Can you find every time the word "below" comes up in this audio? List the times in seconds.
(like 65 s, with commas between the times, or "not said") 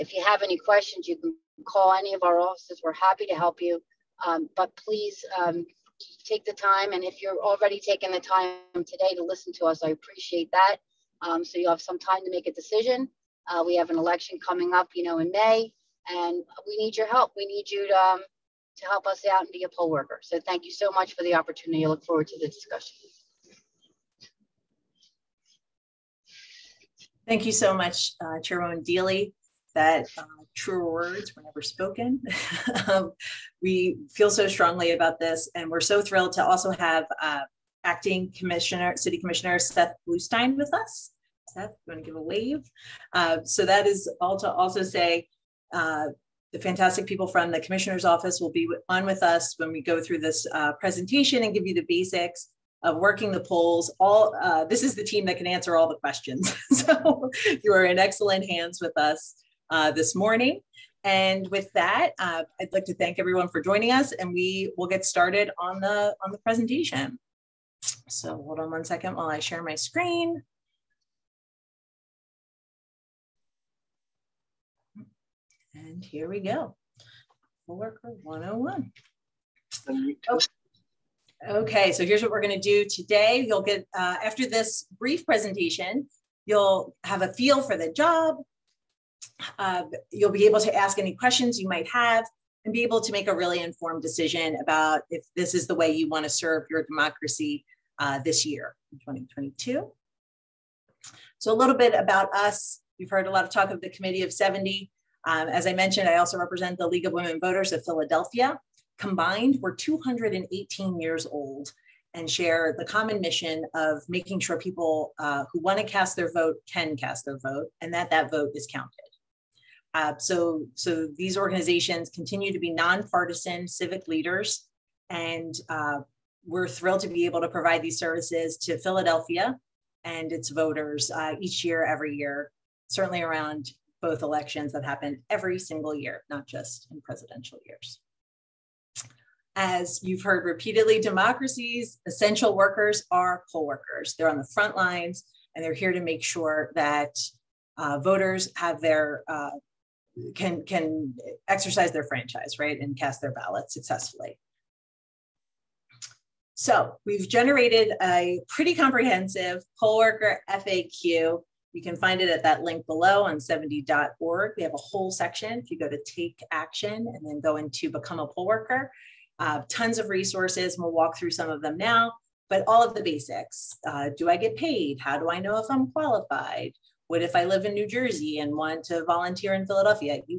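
162 s.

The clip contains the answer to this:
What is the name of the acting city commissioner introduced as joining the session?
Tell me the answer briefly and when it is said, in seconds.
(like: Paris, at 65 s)
Seth Bluestein, at 39 s.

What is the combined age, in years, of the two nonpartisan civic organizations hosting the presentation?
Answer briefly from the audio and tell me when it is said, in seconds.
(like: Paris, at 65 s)
218, at 109 s.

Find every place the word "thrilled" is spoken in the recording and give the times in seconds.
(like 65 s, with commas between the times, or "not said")
36 s, 126 s.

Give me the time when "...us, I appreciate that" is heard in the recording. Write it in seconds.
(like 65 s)
9 s.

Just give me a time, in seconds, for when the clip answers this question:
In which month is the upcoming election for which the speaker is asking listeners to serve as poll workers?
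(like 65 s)
15 s.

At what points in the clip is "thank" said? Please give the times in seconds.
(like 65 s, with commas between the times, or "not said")
20 s, 27 s, 62 s.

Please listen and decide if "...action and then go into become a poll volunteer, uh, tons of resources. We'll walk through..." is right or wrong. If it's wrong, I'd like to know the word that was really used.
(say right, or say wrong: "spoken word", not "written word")
wrong: "worker", not "volunteer".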